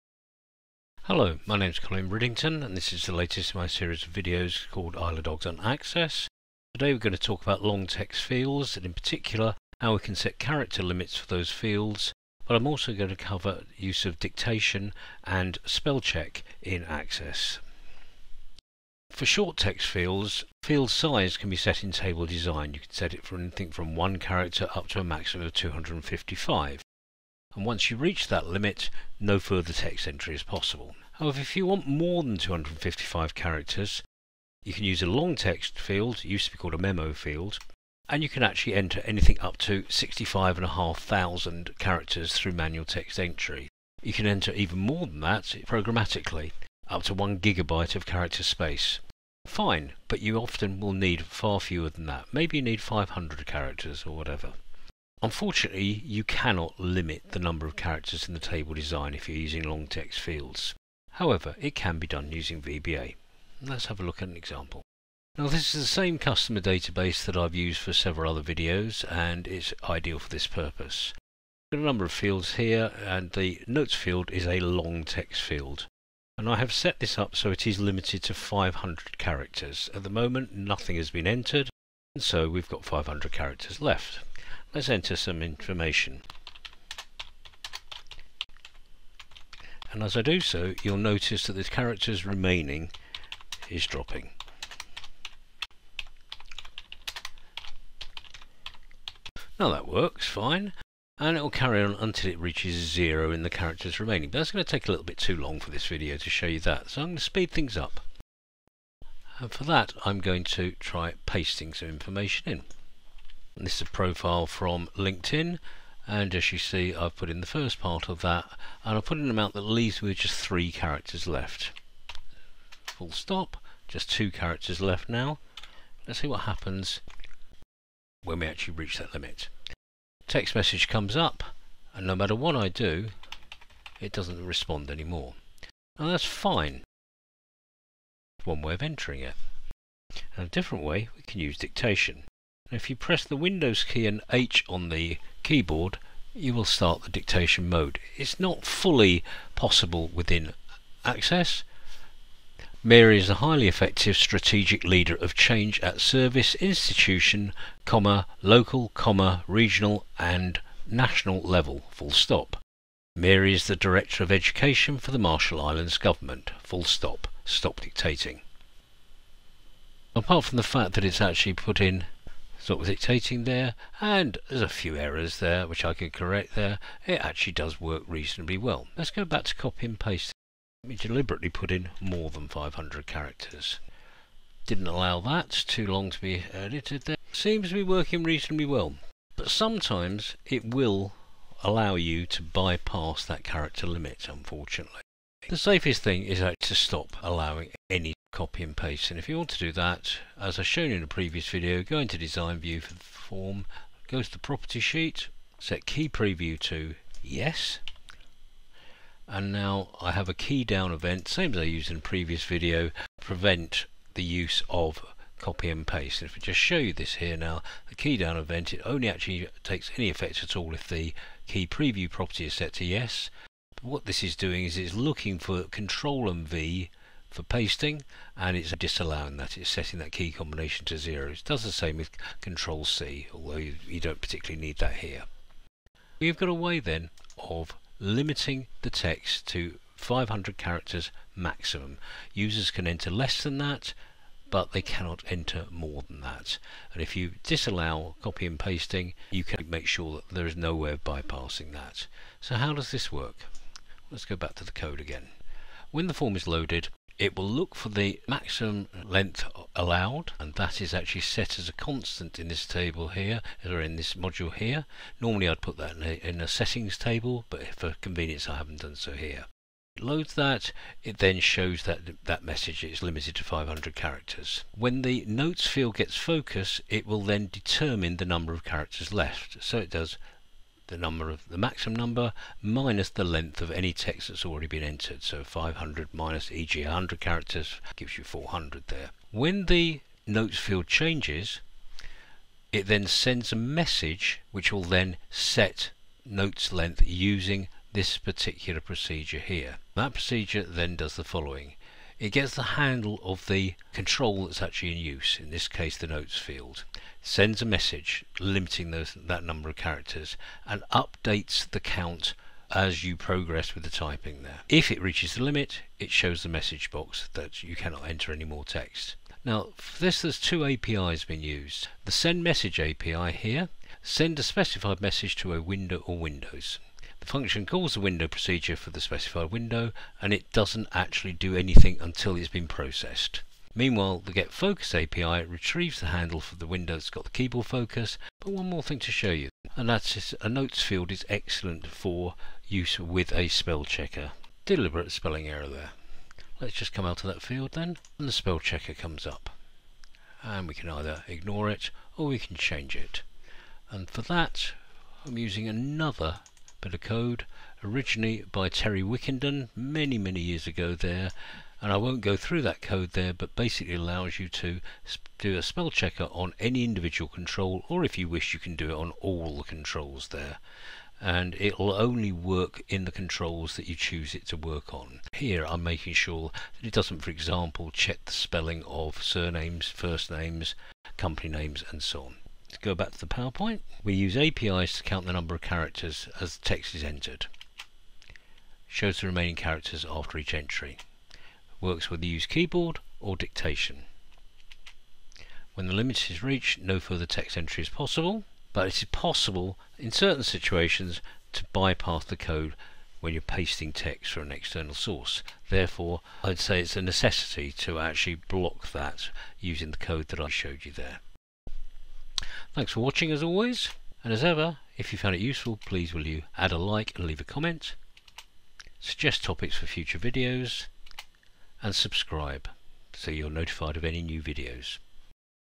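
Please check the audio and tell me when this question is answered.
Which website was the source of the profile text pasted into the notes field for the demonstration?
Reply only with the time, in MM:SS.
01:54.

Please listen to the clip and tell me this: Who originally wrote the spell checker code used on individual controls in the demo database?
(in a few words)
Terry Wickenden.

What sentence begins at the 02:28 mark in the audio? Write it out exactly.
It's not fully possible within Access.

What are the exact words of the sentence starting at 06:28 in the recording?
Shows the remaining characters after each entry.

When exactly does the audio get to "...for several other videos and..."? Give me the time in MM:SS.
01:07.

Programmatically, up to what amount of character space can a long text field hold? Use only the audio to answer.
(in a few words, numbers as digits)
1 gigabyte.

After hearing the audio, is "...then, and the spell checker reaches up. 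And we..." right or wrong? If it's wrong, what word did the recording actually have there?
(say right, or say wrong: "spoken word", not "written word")
wrong: "comes", not "reaches".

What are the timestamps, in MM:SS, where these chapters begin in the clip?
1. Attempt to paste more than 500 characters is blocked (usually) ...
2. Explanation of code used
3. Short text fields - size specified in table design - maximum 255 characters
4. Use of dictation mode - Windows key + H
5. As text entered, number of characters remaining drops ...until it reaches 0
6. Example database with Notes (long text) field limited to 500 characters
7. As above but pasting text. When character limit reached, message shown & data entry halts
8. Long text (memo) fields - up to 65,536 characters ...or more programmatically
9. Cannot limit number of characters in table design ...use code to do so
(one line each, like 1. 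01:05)
1. 03:01
2. 04:15
3. 00:20
4. 02:21
5. 01:37
6. 01:06
7. 01:52
8. 00:32
9. 00:55.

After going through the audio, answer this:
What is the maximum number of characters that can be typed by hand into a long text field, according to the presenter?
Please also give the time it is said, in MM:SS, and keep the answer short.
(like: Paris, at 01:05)
65,500, at 00:39.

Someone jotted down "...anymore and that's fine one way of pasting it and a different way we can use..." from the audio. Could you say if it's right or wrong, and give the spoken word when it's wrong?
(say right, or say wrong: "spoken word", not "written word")
wrong: "entering", not "pasting".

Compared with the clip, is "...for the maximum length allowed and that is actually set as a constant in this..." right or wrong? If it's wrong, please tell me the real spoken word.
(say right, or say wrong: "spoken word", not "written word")
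right.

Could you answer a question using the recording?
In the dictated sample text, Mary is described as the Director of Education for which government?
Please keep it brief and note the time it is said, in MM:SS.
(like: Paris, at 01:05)
Marshall Islands, at 02:45.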